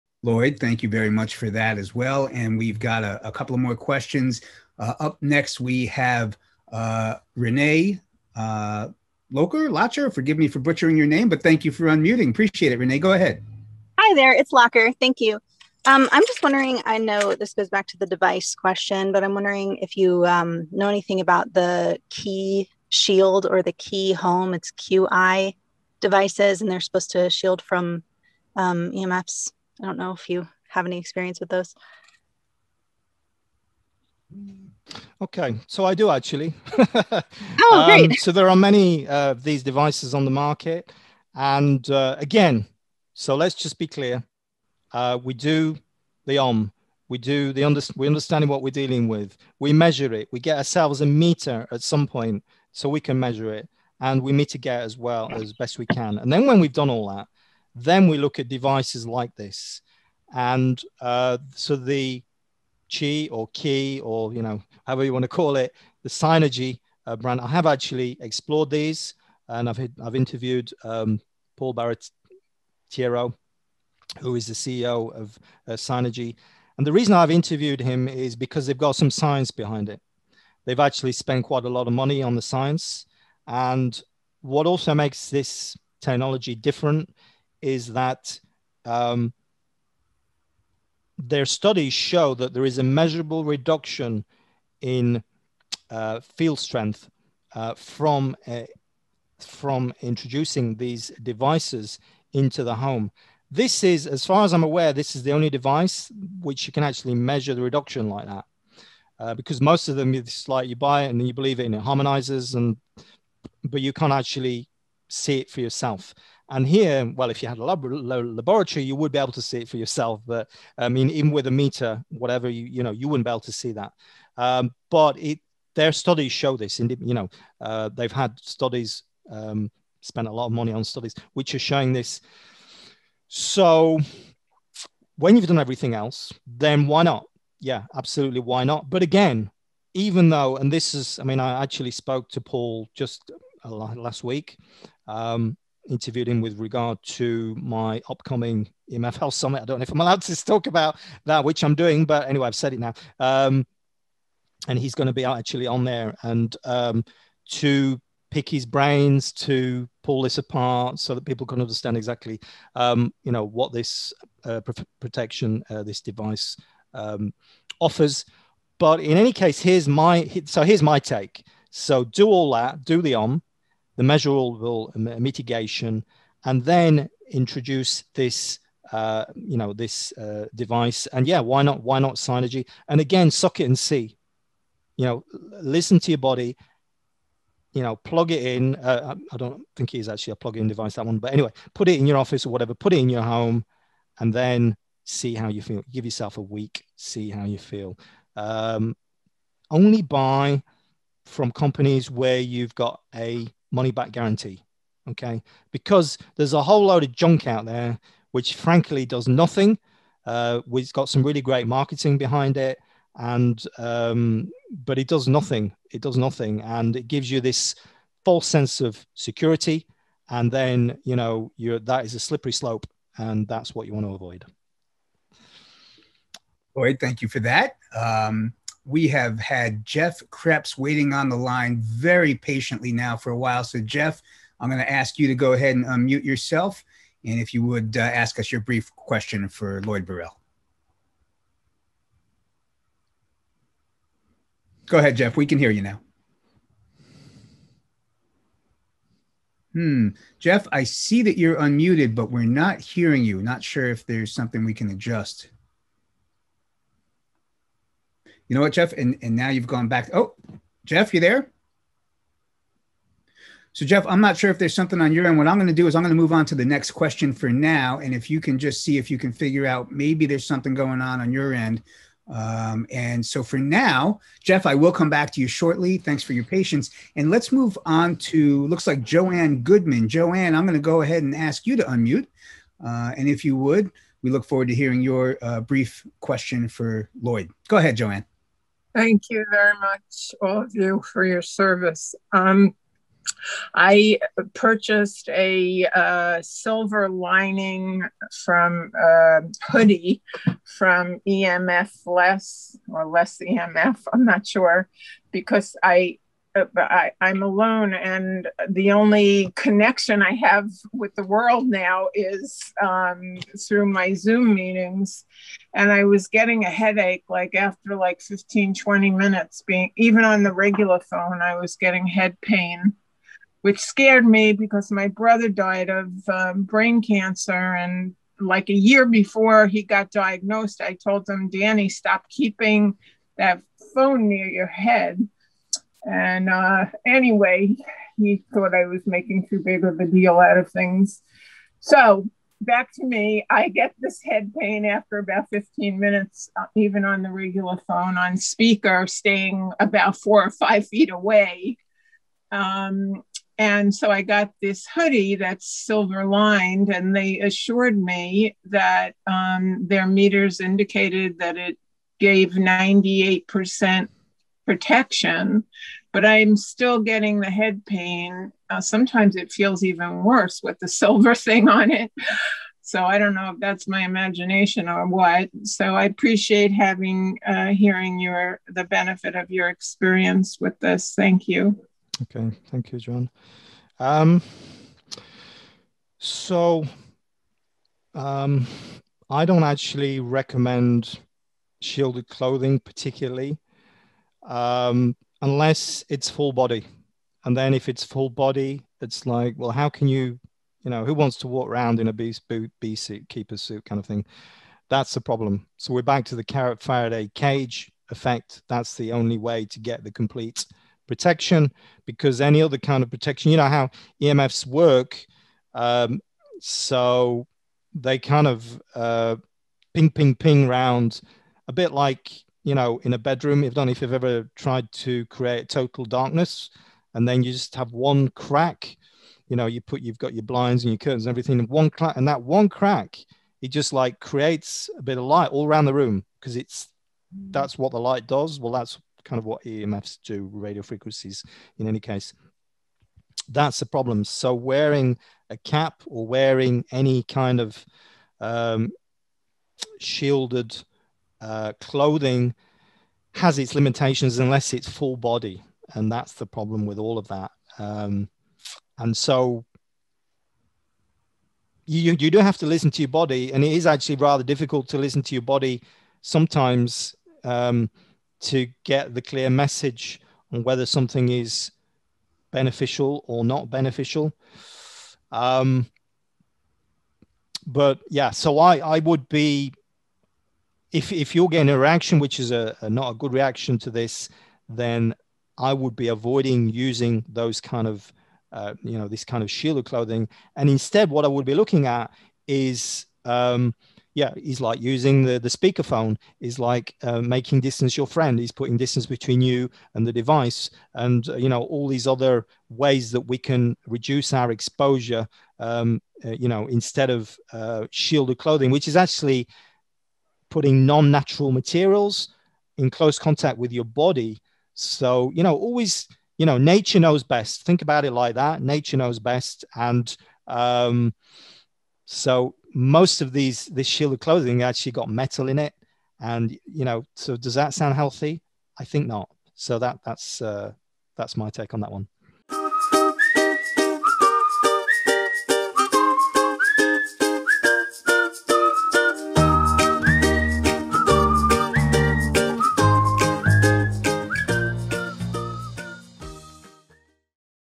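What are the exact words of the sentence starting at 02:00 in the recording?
But I mean, even with a meter, whatever you you know, you wouldn't be able to see that.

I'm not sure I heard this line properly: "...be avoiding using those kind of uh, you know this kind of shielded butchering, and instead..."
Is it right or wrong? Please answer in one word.
wrong.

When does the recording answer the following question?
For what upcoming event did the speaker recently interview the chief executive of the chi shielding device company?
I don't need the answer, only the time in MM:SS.
02:29.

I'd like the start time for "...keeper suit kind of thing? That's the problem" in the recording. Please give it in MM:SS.
06:43.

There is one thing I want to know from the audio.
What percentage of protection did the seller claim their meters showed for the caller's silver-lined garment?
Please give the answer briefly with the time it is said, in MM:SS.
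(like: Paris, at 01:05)
98%, at 06:02.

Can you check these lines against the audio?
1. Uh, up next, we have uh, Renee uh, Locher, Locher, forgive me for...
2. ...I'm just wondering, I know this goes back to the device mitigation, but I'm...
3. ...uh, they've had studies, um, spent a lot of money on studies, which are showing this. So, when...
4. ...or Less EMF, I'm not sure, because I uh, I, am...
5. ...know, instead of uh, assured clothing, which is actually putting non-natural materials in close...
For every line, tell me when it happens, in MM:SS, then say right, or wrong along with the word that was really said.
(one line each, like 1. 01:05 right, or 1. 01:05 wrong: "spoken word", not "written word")
1. 00:04 right
2. 00:16 wrong: "question", not "mitigation"
3. 02:07 right
4. 05:02 right
5. 08:26 wrong: "shielded", not "assured".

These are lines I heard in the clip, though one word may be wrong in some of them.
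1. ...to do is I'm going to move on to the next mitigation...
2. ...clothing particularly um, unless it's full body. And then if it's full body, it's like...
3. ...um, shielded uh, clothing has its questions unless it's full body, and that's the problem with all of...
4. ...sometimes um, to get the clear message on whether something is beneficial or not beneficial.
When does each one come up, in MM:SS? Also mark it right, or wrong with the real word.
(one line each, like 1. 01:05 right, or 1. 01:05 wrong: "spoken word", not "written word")
1. 04:25 wrong: "question", not "mitigation"
2. 06:32 right
3. 07:28 wrong: "limitations", not "questions"
4. 07:46 right.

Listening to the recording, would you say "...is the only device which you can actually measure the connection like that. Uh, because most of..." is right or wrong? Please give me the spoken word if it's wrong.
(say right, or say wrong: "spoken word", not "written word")
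wrong: "reduction", not "connection".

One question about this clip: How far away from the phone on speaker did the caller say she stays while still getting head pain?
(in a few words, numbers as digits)
four or five feet.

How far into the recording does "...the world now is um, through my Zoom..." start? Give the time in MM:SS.
05:11.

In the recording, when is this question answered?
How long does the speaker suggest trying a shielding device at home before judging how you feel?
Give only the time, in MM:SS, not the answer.
03:16.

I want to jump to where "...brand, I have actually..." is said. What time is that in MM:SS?
01:07.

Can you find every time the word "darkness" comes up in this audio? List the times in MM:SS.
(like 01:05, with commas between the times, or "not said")
07:06.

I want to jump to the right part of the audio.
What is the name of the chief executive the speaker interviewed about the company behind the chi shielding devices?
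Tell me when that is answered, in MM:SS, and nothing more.
01:11.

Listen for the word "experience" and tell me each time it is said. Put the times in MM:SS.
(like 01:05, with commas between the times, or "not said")
00:30, 06:19.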